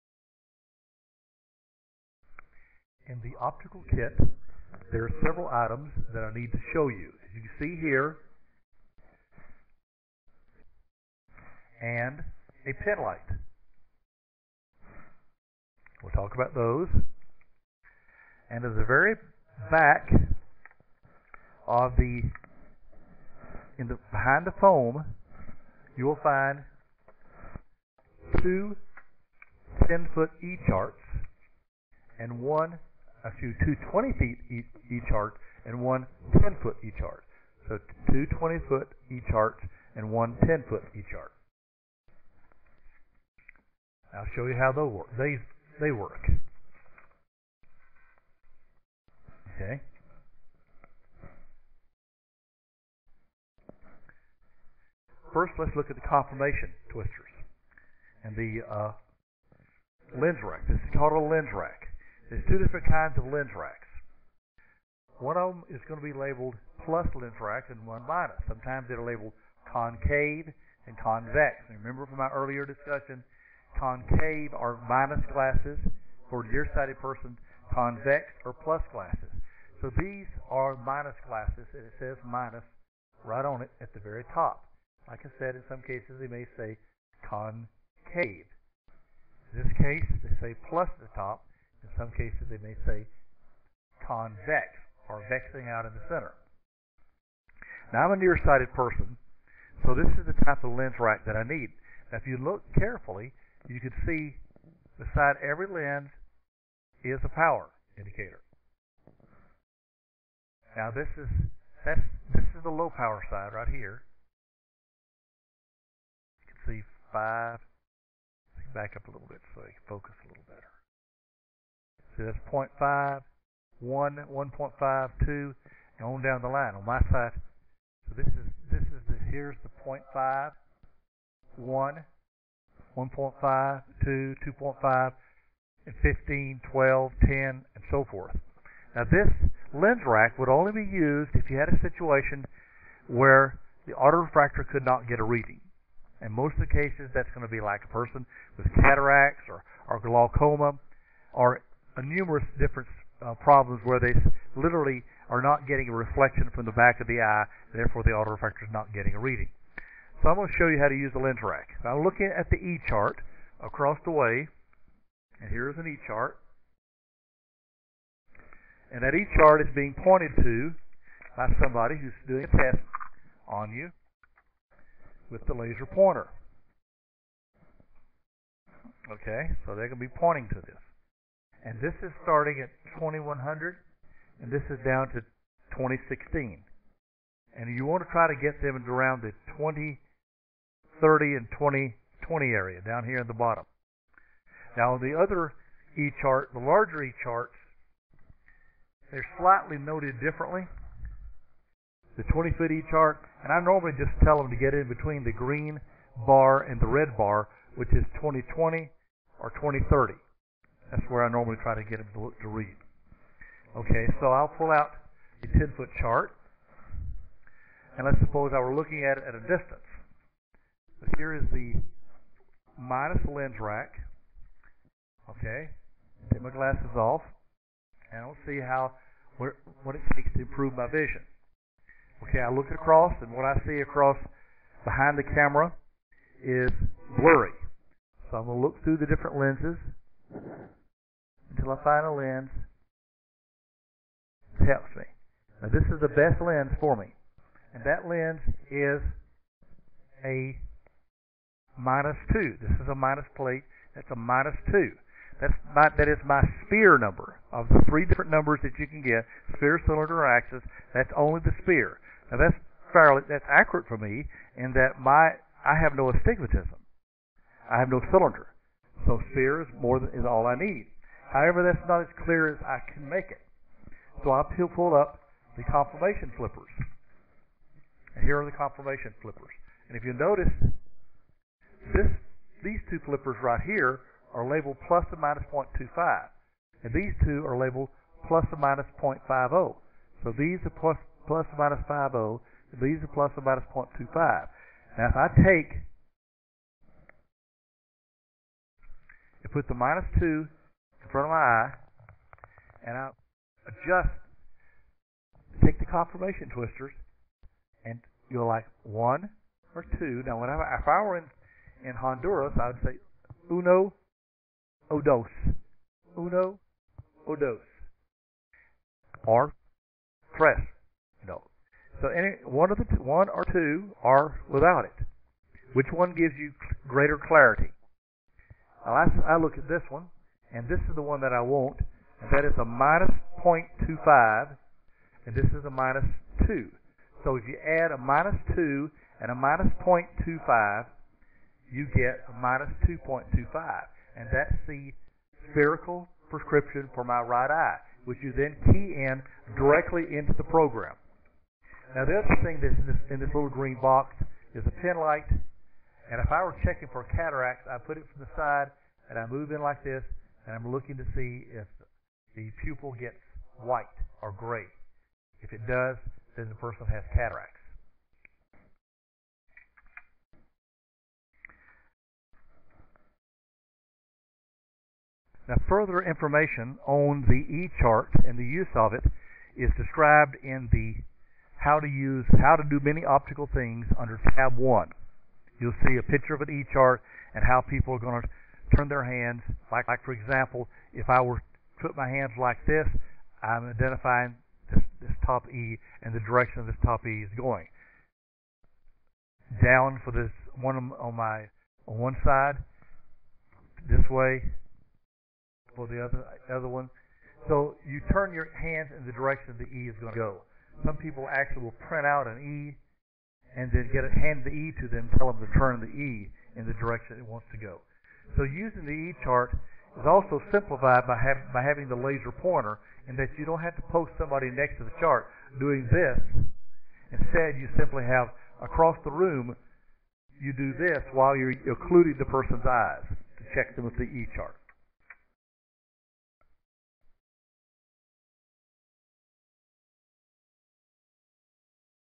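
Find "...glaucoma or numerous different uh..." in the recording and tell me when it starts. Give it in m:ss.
2:29.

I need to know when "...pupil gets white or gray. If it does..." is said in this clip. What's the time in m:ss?
6:02.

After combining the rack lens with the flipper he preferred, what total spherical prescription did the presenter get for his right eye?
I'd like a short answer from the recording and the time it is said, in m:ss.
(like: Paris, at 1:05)
minus 2.25, at 5:42.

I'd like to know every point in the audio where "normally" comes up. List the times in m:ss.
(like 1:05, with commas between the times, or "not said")
3:23, 3:31.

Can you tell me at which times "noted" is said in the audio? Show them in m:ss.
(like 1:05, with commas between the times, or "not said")
3:19.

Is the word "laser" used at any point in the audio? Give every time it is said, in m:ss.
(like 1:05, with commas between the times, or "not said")
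2:55, 7:01.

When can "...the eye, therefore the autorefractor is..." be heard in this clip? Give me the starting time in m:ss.
2:37.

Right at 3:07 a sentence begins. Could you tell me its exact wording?
And you want to try to get them around the 20, 30, and 2020 area down here in the bottom.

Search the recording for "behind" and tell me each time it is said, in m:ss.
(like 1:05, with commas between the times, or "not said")
0:24, 3:54.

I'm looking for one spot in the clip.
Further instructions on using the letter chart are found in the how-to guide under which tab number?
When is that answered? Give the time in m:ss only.
6:24.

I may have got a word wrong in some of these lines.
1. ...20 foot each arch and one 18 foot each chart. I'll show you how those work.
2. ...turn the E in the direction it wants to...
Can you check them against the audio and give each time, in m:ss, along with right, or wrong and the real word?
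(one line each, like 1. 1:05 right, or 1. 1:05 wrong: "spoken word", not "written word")
1. 0:38 wrong: "10", not "18"
2. 6:55 right.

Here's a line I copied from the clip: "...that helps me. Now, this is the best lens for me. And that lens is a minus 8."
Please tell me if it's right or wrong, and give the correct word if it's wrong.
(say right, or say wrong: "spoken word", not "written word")
wrong: "2", not "8".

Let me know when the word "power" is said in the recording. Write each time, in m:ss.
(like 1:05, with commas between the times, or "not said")
1:47, 1:52.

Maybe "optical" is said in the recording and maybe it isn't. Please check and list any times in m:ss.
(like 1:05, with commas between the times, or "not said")
0:03, 6:23.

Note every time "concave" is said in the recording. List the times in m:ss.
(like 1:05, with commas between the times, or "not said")
1:09, 1:13, 1:27.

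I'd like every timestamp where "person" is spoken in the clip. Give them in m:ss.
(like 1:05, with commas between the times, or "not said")
1:17, 1:38, 2:27, 6:06, 7:12.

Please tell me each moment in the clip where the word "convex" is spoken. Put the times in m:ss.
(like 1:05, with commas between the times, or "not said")
1:10, 1:17, 1:34.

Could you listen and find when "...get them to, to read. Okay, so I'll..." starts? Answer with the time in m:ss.
3:31.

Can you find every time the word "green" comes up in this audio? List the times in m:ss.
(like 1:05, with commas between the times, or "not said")
3:25, 5:53.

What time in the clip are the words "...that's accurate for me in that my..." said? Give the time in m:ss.
4:23.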